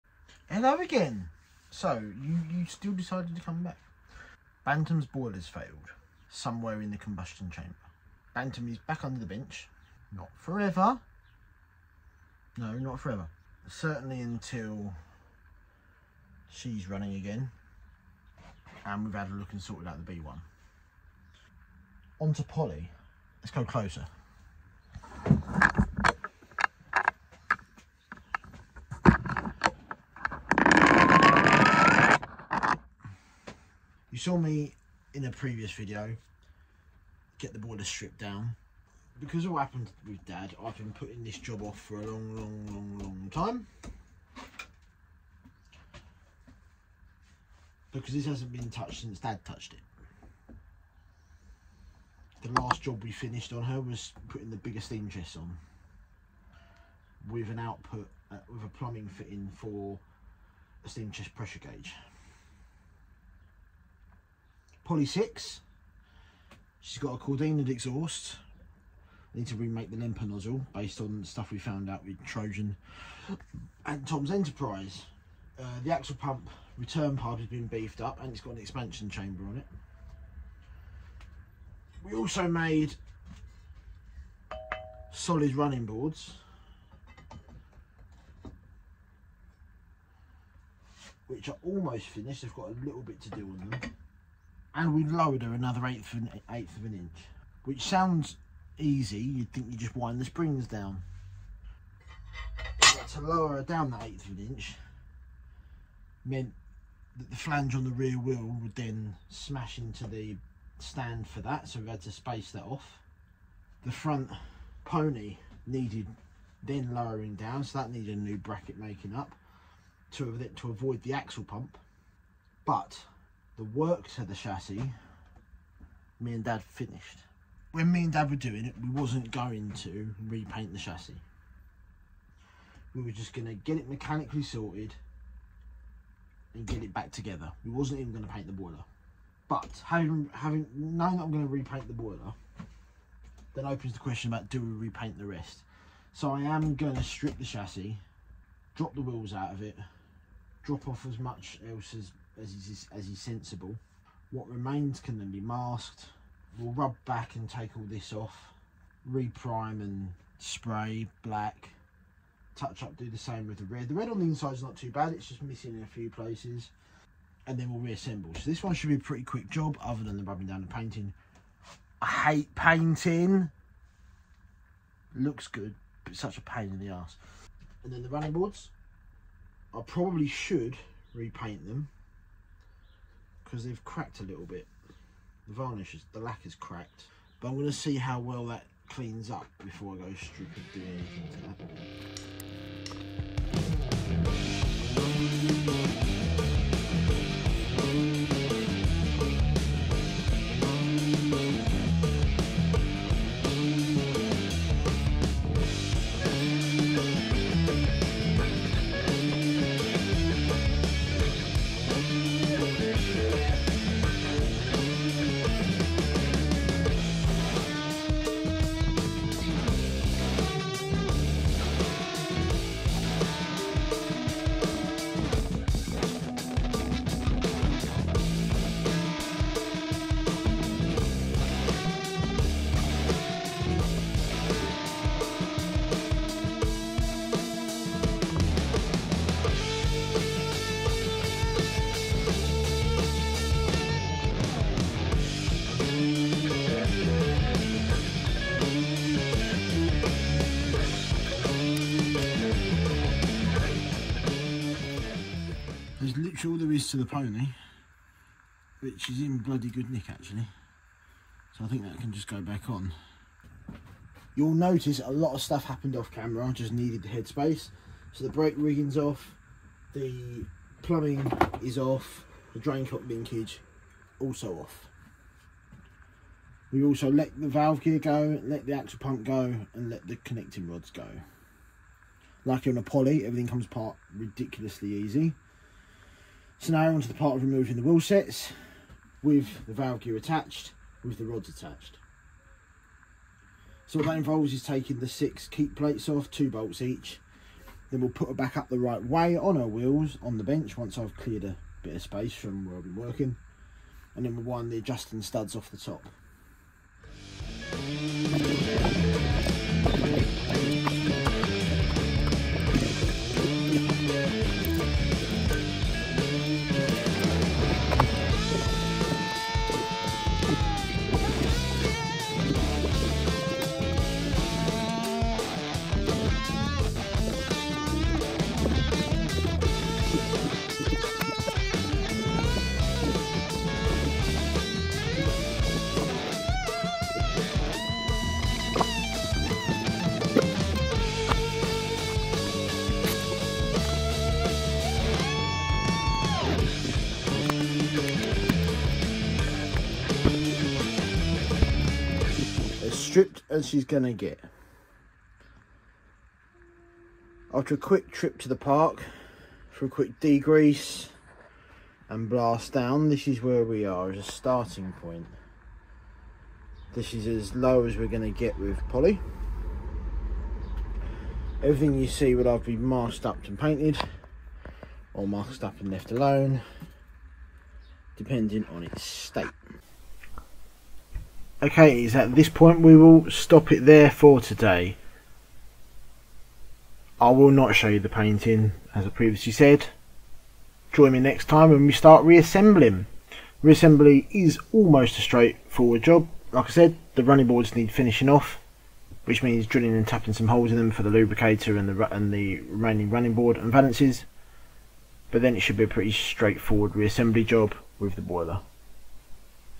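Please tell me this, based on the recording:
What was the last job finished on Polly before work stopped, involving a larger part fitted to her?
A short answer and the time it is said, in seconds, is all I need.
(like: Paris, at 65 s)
bigger steam chest, at 54 s.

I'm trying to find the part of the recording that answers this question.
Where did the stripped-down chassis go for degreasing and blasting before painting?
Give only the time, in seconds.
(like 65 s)
358 s.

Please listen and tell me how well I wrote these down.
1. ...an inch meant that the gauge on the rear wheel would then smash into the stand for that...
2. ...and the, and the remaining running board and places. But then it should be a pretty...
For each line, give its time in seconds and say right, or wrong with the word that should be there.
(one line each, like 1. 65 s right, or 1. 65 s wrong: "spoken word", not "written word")
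1. 104 s wrong: "flange", not "gauge"
2. 401 s wrong: "valances", not "places".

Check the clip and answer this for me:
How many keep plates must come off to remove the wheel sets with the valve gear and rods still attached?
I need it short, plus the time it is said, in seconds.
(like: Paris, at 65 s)
6, at 295 s.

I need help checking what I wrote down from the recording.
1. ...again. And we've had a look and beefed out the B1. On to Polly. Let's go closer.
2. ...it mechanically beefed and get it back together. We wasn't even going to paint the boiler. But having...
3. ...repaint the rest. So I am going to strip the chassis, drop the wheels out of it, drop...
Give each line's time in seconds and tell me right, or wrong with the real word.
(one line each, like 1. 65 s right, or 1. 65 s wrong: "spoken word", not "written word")
1. 17 s wrong: "sorted", not "beefed"
2. 133 s wrong: "sorted", not "beefed"
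3. 144 s right.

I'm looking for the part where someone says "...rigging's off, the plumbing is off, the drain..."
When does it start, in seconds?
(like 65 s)
268 s.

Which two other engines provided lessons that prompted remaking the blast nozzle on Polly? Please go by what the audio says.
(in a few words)
Trojan and Tom's Enterprise.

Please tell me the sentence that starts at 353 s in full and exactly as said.
stripped as she's going to get.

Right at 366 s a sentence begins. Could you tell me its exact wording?
This is as low as we're going to get with Polly.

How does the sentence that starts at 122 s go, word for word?
But the work to the chassis, me and Dad finished.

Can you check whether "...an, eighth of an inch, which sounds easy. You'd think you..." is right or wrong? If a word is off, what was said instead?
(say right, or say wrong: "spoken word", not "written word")
right.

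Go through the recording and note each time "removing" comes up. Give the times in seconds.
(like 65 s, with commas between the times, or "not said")
287 s.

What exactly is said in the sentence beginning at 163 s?
The red on the inside is not too bad, it's just missing in a few places.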